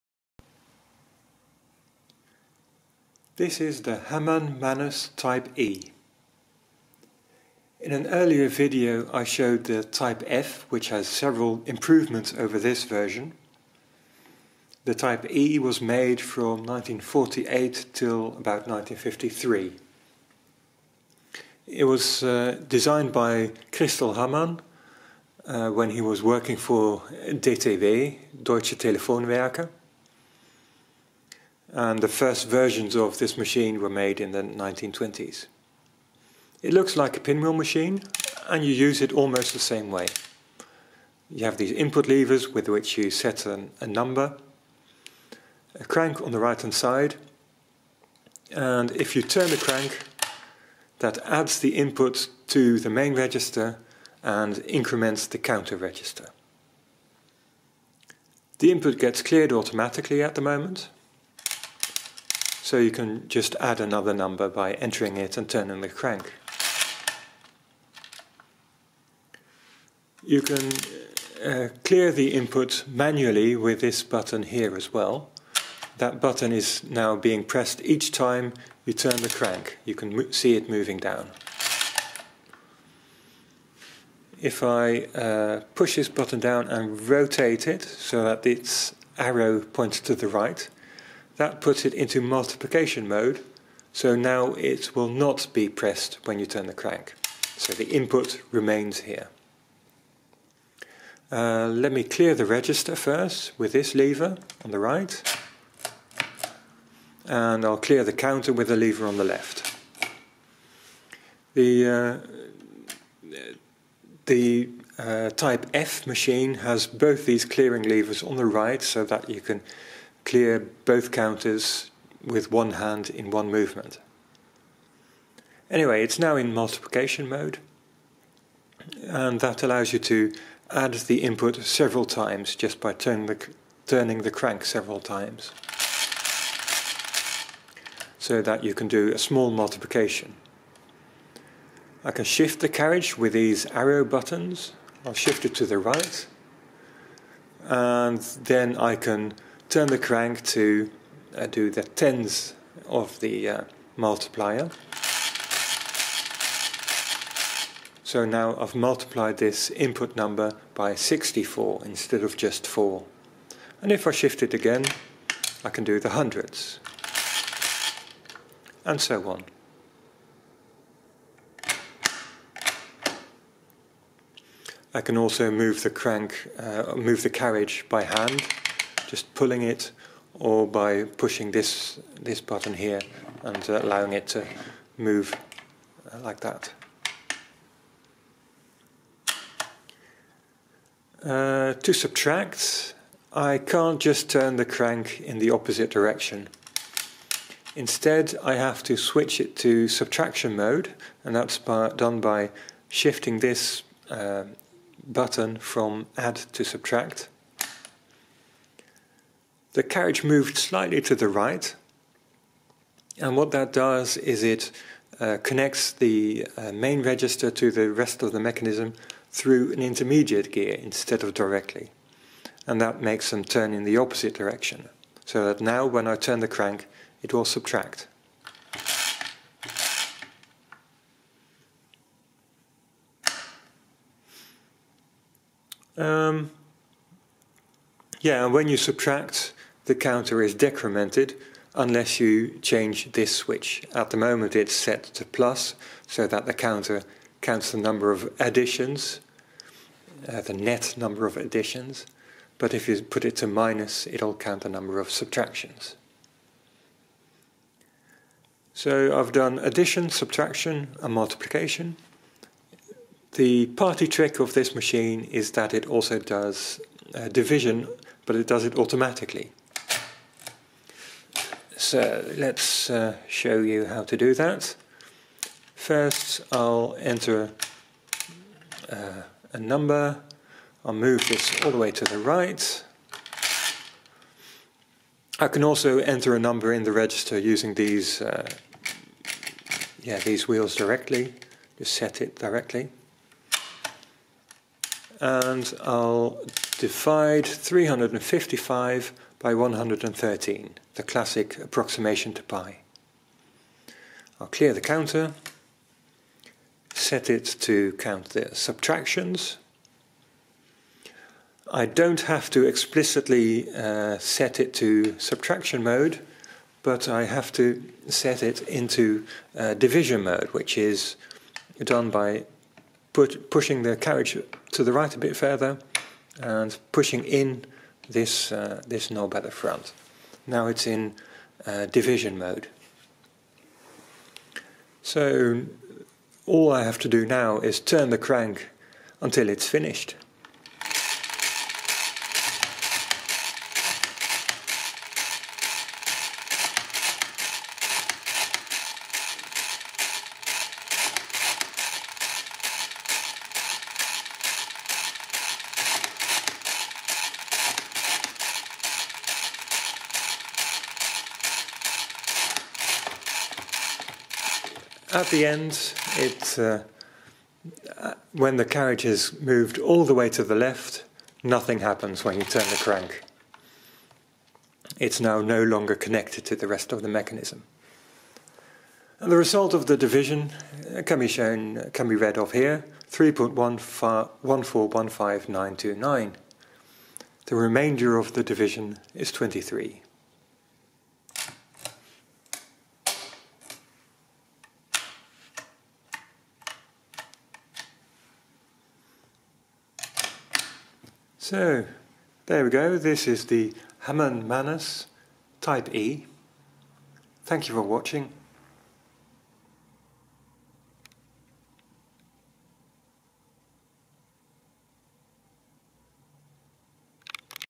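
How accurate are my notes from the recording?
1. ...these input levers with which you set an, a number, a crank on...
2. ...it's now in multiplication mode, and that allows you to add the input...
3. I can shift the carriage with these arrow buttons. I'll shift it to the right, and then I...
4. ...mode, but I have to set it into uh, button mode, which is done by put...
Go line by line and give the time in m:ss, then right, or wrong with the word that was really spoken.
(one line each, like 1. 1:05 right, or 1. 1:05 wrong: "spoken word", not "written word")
1. 0:41 right
2. 2:06 right
3. 2:22 right
4. 5:15 wrong: "division", not "button".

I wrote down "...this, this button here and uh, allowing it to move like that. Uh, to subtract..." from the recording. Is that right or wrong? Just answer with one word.
right.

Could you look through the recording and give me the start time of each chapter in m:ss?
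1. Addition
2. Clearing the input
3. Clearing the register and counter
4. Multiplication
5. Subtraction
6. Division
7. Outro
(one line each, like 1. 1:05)
1. 0:35
2. 0:57
3. 1:40
4. 2:05
5. 3:10
6. 4:17
7. 6:30.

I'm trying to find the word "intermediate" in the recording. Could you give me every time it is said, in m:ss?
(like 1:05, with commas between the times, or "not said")
3:39.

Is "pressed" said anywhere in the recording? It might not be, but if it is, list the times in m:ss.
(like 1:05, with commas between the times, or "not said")
1:17, 1:35.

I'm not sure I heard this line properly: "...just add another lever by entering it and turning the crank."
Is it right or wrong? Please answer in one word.
wrong.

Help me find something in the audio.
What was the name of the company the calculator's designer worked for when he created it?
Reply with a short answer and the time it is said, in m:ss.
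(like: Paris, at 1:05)
Deutsche Telefonwerke, at 0:28.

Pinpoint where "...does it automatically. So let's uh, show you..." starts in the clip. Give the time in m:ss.
4:28.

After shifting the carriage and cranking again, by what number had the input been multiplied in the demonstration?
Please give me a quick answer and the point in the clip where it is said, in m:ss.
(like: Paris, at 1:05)
64, at 2:40.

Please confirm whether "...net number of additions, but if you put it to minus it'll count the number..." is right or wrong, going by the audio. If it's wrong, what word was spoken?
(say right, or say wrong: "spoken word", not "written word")
right.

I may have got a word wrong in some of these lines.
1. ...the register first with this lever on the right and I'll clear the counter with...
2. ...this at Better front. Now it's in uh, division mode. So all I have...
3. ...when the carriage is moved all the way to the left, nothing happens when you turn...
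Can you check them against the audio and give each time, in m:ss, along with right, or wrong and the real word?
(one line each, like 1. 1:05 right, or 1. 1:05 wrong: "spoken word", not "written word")
1. 1:42 right
2. 5:28 right
3. 6:08 right.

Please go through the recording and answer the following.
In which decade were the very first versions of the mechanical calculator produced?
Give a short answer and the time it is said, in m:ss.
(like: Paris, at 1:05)
1920s, at 0:34.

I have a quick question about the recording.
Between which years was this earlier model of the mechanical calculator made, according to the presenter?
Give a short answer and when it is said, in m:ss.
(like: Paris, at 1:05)
1948 till about 1953, at 0:16.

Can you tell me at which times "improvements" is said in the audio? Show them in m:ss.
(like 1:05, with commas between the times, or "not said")
0:11.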